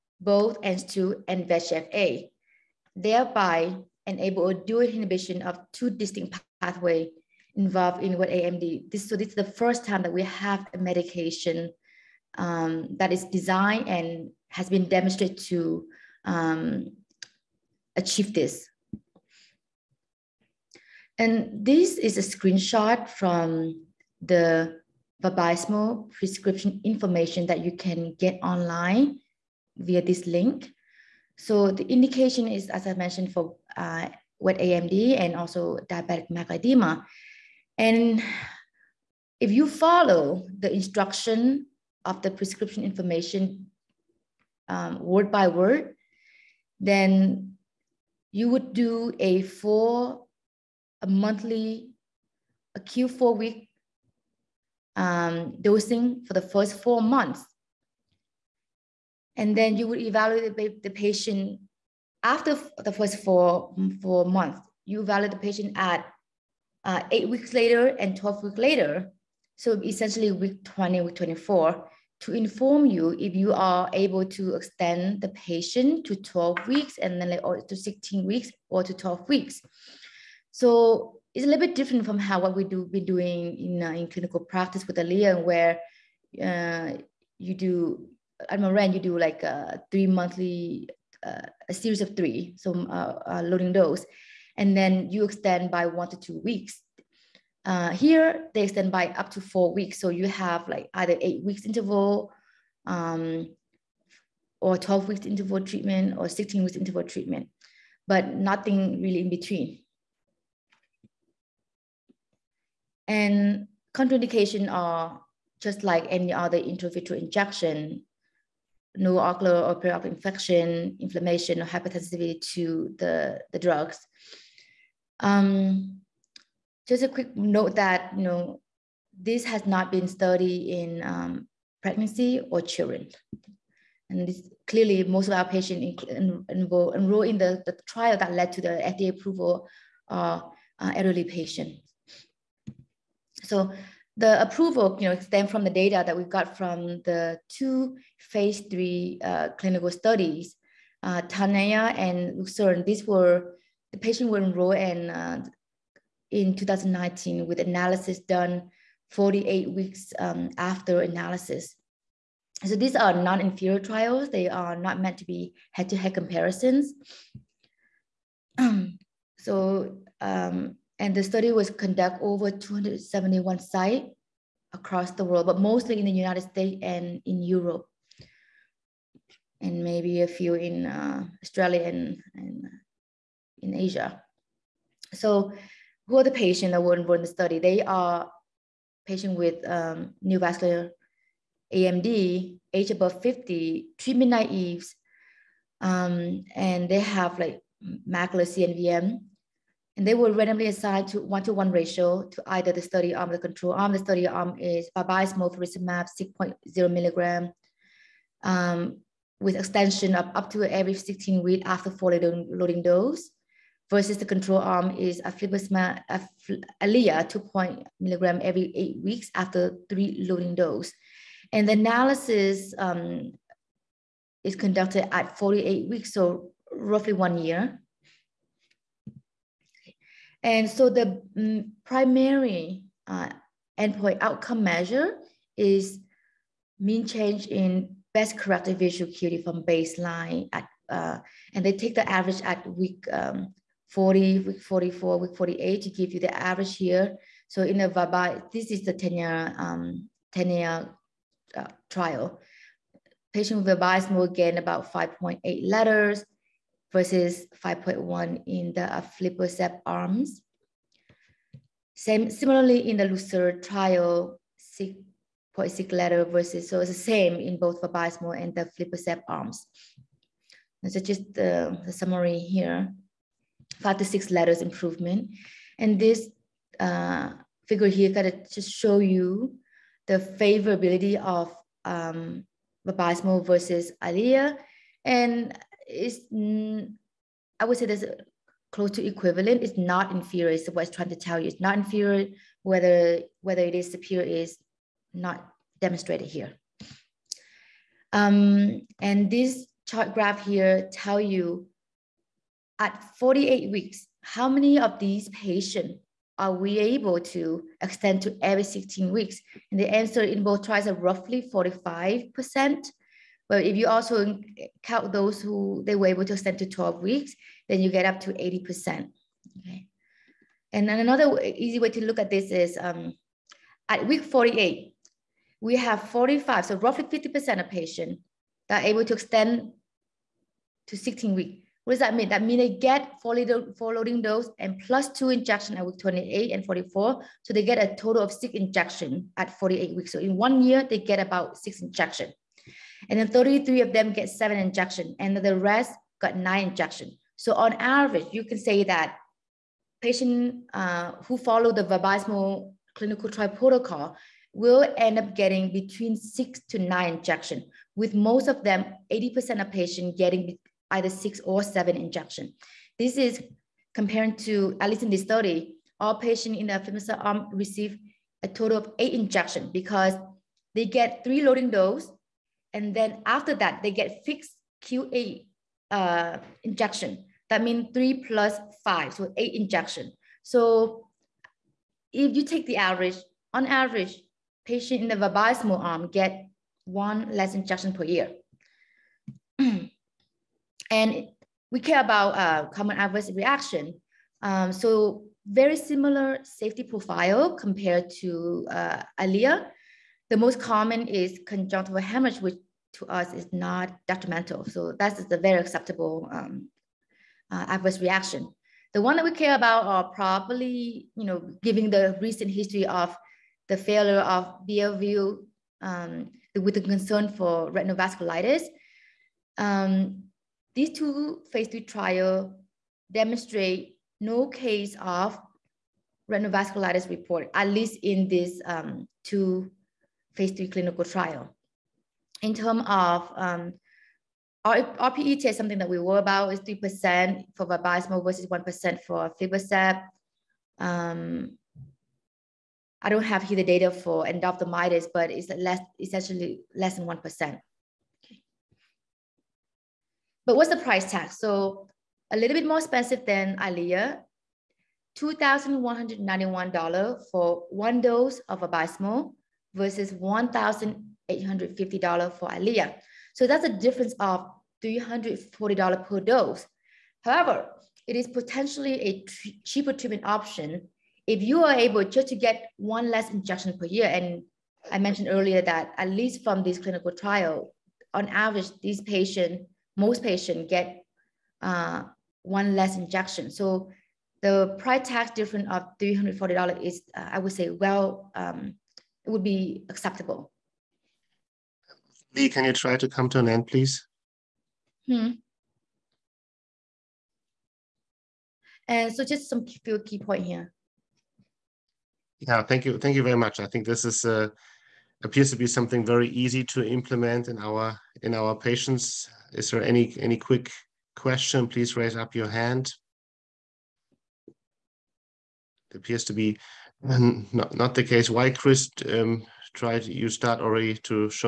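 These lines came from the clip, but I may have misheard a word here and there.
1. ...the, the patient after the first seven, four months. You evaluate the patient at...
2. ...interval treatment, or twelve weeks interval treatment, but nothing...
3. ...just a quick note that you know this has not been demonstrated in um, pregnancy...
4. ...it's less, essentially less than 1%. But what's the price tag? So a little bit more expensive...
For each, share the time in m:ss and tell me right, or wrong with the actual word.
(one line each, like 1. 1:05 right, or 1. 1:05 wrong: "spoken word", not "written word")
1. 1:00 wrong: "four", not "seven"
2. 1:45 wrong: "sixteen", not "twelve"
3. 2:06 wrong: "studied", not "demonstrated"
4. 7:25 right.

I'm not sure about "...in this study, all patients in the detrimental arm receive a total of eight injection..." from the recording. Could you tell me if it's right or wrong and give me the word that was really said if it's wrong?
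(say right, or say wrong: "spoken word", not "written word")
wrong: "femoral", not "detrimental".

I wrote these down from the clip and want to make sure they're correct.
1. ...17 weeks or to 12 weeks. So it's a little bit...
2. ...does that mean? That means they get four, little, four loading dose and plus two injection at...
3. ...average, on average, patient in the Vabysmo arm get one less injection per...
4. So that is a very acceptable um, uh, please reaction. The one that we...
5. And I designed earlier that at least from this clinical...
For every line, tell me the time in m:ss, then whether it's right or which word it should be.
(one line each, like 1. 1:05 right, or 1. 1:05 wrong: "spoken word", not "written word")
1. 1:17 wrong: "16", not "17"
2. 5:31 right
3. 6:22 right
4. 6:44 wrong: "adverse", not "please"
5. 7:54 wrong: "mentioned", not "designed".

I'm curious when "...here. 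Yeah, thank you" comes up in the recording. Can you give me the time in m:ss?
8:20.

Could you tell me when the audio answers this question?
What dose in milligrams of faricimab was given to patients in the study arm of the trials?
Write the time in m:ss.
3:26.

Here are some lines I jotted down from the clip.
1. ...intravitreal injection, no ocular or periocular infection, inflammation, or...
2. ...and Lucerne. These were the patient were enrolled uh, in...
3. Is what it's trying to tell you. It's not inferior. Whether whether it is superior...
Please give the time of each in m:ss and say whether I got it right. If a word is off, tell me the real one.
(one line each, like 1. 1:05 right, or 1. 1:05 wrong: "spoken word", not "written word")
1. 1:56 right
2. 2:31 right
3. 4:50 right.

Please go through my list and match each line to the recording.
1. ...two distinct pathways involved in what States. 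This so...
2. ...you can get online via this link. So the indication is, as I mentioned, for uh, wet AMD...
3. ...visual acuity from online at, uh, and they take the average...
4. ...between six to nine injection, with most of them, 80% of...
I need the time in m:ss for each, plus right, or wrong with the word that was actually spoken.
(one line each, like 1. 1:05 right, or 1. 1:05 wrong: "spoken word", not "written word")
1. 0:05 wrong: "AMD", not "States"
2. 0:27 right
3. 3:58 wrong: "baseline", not "online"
4. 5:55 right.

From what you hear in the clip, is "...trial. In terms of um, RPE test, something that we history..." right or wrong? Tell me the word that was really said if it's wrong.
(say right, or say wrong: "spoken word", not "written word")
wrong: "worry", not "history".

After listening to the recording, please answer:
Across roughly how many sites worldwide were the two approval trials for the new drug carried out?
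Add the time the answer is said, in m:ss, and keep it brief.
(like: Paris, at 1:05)
271, at 2:52.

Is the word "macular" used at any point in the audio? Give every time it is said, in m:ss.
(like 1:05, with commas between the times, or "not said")
0:36, 3:17.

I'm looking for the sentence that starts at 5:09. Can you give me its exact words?
And the answer in both trials are roughly 45%.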